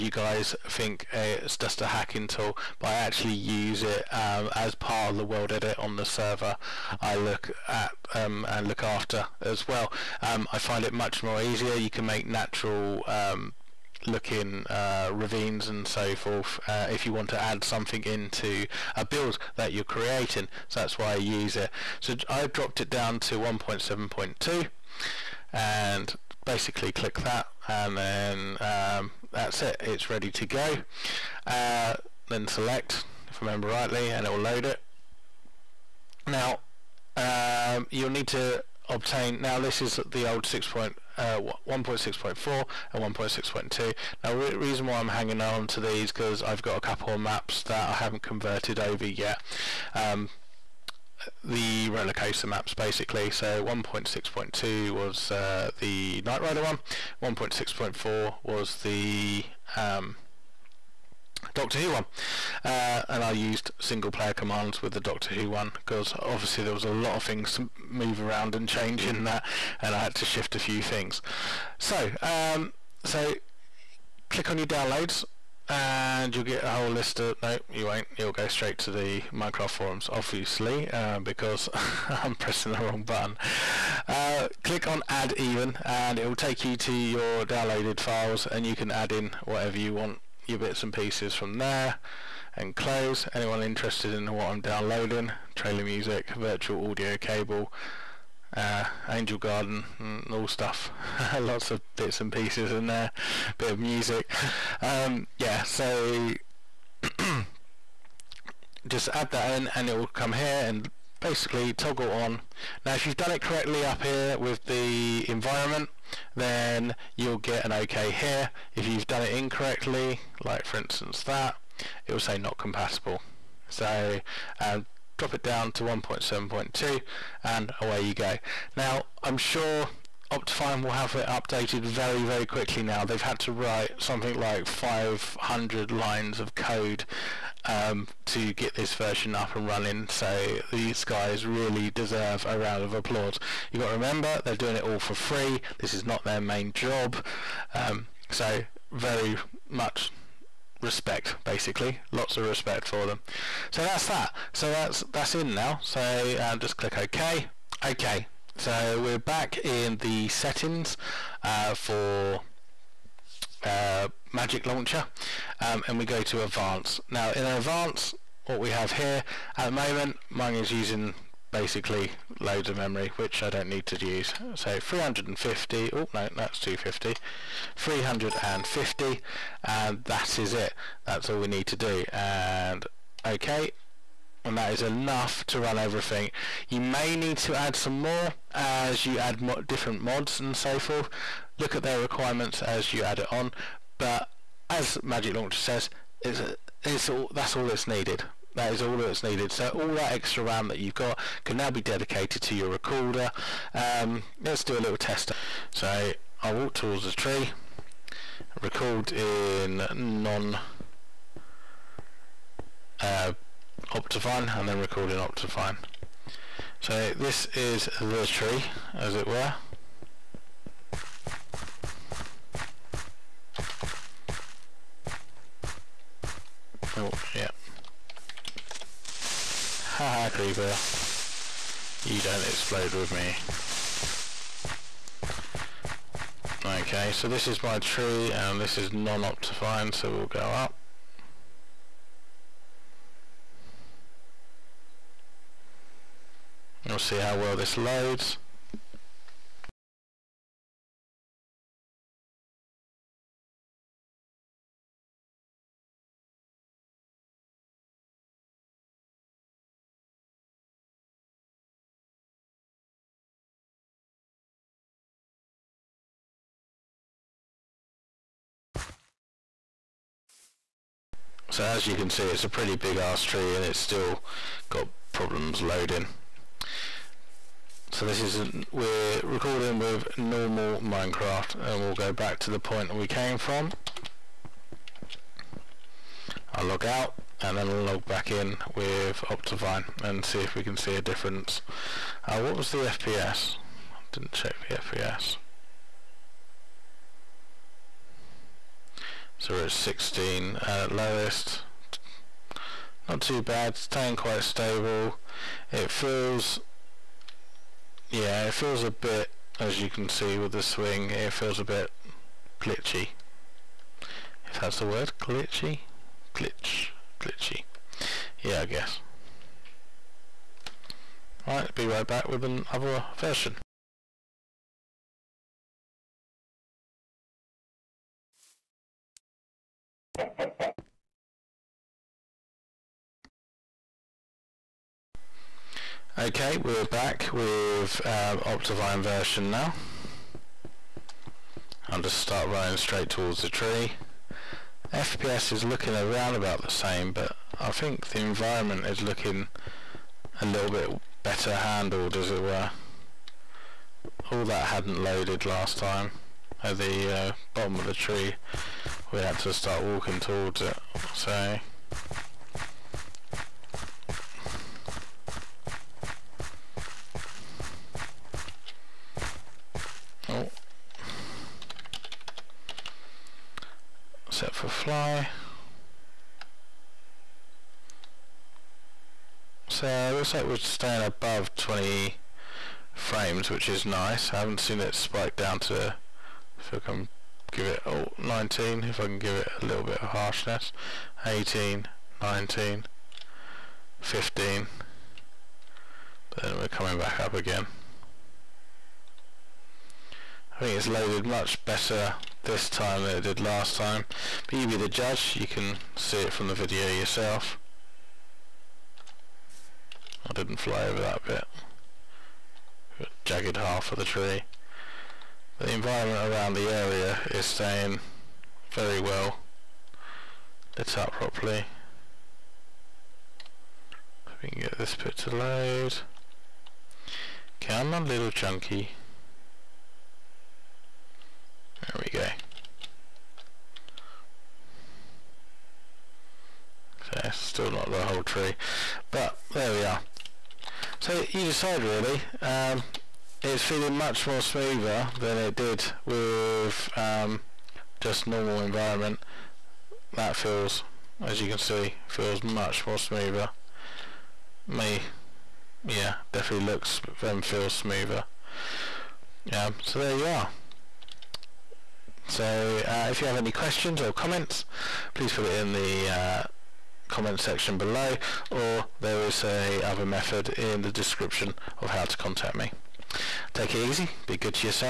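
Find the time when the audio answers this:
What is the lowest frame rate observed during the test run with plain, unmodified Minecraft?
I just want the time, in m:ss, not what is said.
4:59.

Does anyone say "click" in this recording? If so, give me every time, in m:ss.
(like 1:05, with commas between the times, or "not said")
0:26, 1:14, 1:24, 2:36.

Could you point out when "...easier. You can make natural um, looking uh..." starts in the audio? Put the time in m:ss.
0:11.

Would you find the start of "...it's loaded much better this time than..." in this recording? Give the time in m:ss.
6:40.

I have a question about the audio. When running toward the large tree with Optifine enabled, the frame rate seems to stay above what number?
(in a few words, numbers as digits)
20.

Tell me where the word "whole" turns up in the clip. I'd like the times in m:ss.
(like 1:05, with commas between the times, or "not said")
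1:16, 7:18.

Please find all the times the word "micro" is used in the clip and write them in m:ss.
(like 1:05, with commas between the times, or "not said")
not said.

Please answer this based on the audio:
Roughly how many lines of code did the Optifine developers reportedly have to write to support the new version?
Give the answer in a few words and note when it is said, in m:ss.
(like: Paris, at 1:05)
500, at 2:14.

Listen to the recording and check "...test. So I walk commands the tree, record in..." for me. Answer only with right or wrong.
wrong.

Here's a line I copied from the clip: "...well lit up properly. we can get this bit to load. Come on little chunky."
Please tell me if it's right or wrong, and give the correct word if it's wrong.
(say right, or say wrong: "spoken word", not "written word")
right.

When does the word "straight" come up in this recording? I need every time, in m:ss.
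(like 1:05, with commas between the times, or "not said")
1:18, 5:42.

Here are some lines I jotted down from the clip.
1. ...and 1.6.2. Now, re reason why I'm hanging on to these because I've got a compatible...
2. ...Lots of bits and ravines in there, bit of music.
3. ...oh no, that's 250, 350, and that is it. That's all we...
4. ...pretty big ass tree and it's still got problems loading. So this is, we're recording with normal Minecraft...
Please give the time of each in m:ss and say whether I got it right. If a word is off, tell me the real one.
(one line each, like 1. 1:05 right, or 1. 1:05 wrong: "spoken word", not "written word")
1. 0:42 wrong: "couple", not "compatible"
2. 1:41 wrong: "pieces", not "ravines"
3. 2:55 right
4. 4:32 right.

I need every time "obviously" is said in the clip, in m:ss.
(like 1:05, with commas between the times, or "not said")
1:06, 1:20.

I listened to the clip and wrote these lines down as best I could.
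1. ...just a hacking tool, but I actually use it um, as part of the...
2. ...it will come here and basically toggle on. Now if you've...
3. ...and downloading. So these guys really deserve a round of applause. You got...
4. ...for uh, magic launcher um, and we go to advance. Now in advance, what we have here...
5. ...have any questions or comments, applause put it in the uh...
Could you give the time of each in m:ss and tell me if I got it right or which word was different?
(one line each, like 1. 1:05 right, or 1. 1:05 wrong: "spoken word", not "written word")
1. 0:01 right
2. 1:49 right
3. 2:19 wrong: "running", not "downloading"
4. 2:41 right
5. 7:43 wrong: "please", not "applause".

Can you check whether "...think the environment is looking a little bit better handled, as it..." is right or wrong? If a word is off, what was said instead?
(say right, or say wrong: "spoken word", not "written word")
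right.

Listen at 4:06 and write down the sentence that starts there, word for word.
We'll see how well this loads.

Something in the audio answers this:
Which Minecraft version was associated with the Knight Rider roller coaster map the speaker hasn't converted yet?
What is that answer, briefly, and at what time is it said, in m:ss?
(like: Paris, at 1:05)
1.6.2, at 0:53.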